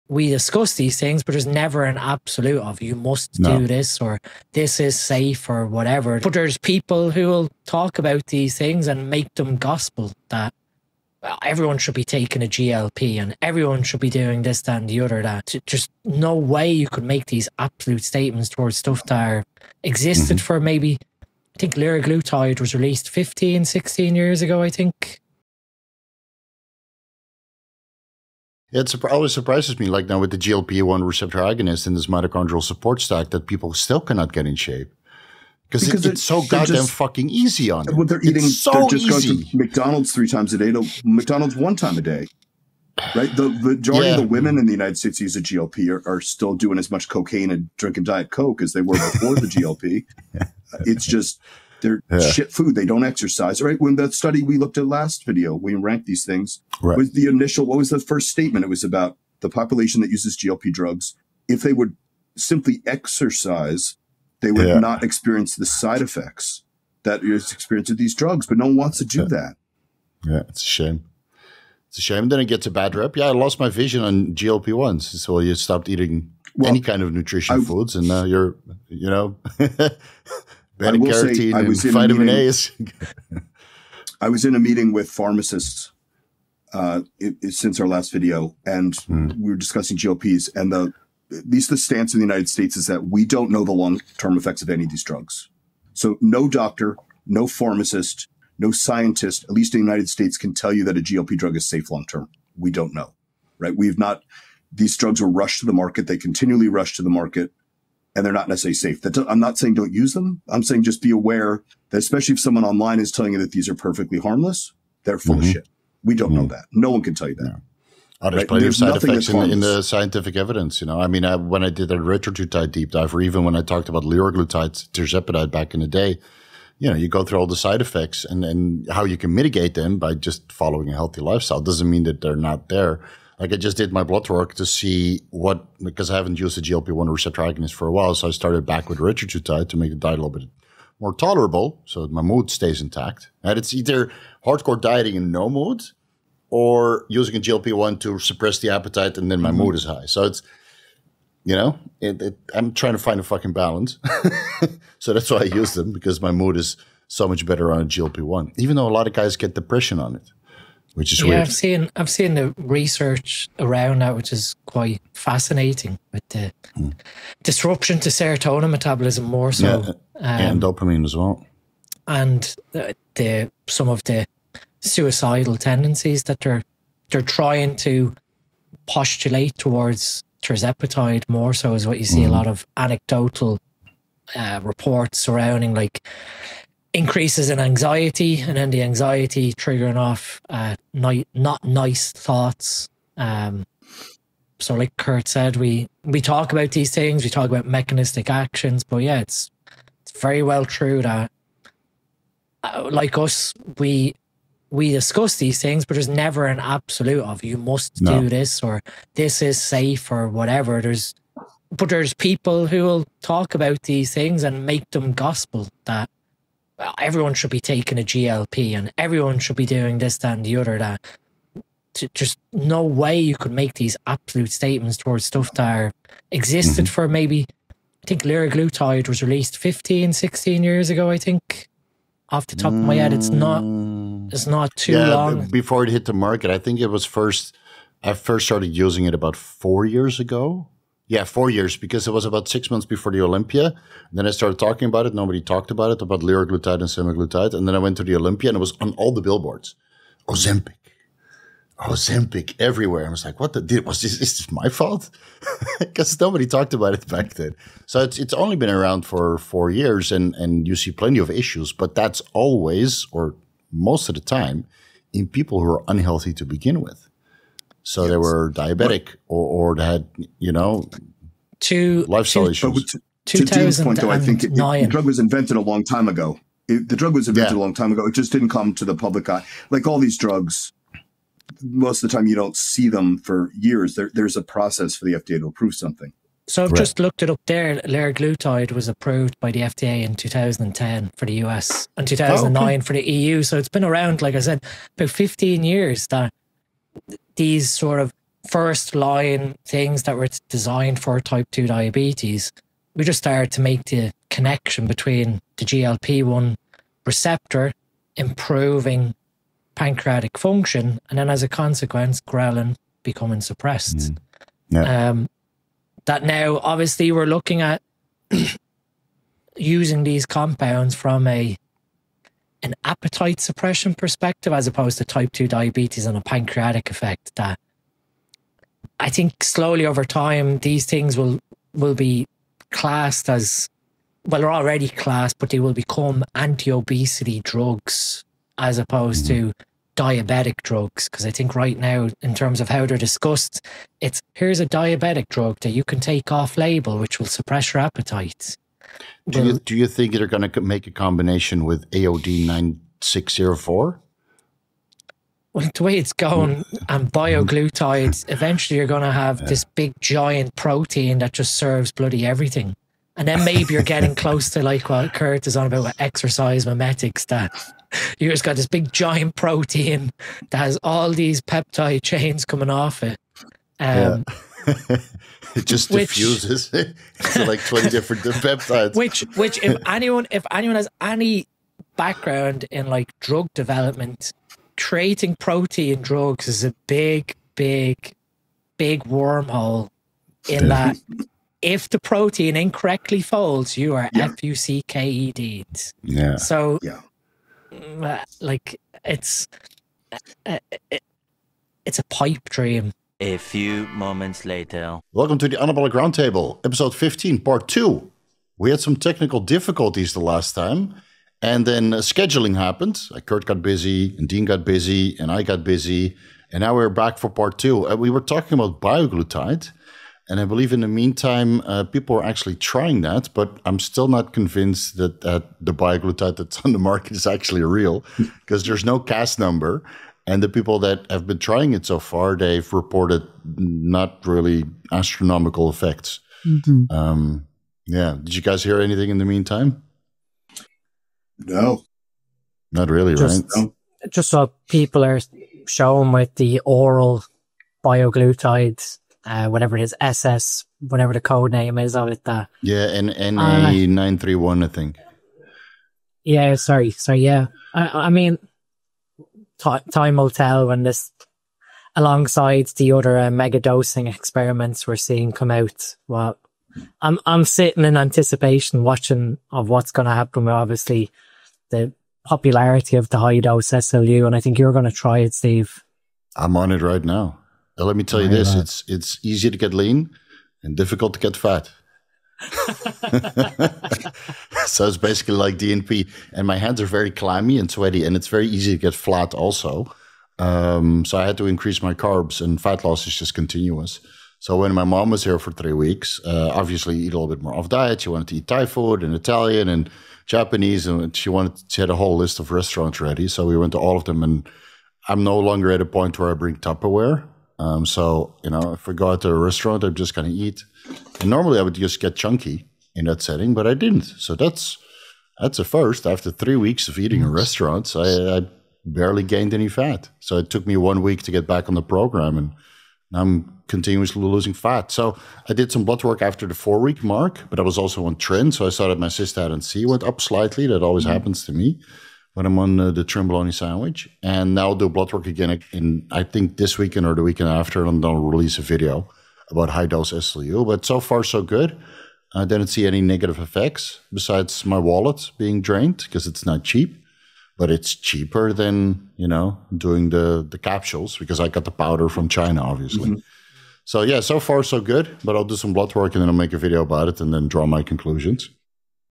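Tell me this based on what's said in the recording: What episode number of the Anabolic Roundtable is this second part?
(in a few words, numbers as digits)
15.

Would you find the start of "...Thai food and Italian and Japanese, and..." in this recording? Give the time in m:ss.
8:18.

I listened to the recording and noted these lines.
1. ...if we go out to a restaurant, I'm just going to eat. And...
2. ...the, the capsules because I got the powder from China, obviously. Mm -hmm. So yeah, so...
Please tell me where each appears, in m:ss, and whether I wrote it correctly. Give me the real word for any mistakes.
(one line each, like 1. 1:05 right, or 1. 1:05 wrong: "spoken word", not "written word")
1. 8:28 right
2. 9:10 right.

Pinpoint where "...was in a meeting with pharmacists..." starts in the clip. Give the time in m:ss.
1:24.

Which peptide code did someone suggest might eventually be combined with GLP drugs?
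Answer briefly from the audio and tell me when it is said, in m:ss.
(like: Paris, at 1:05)
AOD 9604, at 5:51.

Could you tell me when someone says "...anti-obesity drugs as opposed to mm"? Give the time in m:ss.
5:36.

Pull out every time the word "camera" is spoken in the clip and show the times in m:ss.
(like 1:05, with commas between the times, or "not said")
not said.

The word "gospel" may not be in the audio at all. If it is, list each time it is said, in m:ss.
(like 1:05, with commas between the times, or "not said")
0:09, 3:35.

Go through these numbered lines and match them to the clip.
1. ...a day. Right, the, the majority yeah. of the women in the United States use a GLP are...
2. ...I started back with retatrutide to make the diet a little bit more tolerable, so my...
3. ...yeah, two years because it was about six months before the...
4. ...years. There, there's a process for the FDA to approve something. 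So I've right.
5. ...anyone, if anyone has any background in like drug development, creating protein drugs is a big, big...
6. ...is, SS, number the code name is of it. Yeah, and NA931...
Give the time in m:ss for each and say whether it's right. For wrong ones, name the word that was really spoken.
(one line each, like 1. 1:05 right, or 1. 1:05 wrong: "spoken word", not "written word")
1. 0:41 right
2. 2:18 right
3. 4:01 wrong: "four", not "two"
4. 4:43 right
5. 6:19 right
6. 7:29 wrong: "whatever", not "number".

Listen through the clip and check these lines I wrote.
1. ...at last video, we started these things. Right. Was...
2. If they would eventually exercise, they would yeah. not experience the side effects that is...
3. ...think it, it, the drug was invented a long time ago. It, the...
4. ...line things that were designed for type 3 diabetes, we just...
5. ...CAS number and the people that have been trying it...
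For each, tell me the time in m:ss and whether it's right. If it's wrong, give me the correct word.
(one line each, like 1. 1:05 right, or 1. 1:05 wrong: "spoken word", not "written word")
1. 0:54 wrong: "ranked", not "started"
2. 1:01 wrong: "simply", not "eventually"
3. 4:34 right
4. 4:58 wrong: "2", not "3"
5. 7:08 right.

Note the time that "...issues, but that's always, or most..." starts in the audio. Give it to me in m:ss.
4:21.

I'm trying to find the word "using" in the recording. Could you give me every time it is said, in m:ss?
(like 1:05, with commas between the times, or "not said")
2:27, 3:58, 5:19.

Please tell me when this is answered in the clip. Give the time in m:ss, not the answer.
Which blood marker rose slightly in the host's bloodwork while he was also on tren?
8:49.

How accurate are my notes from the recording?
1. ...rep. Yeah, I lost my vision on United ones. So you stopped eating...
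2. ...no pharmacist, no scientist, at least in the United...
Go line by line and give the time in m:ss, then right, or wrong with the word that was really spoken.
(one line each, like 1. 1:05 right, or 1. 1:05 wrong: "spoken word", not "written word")
1. 1:12 wrong: "GLP", not "United"
2. 1:37 right.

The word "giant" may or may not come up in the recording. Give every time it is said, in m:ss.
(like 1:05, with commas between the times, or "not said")
5:59, 6:08.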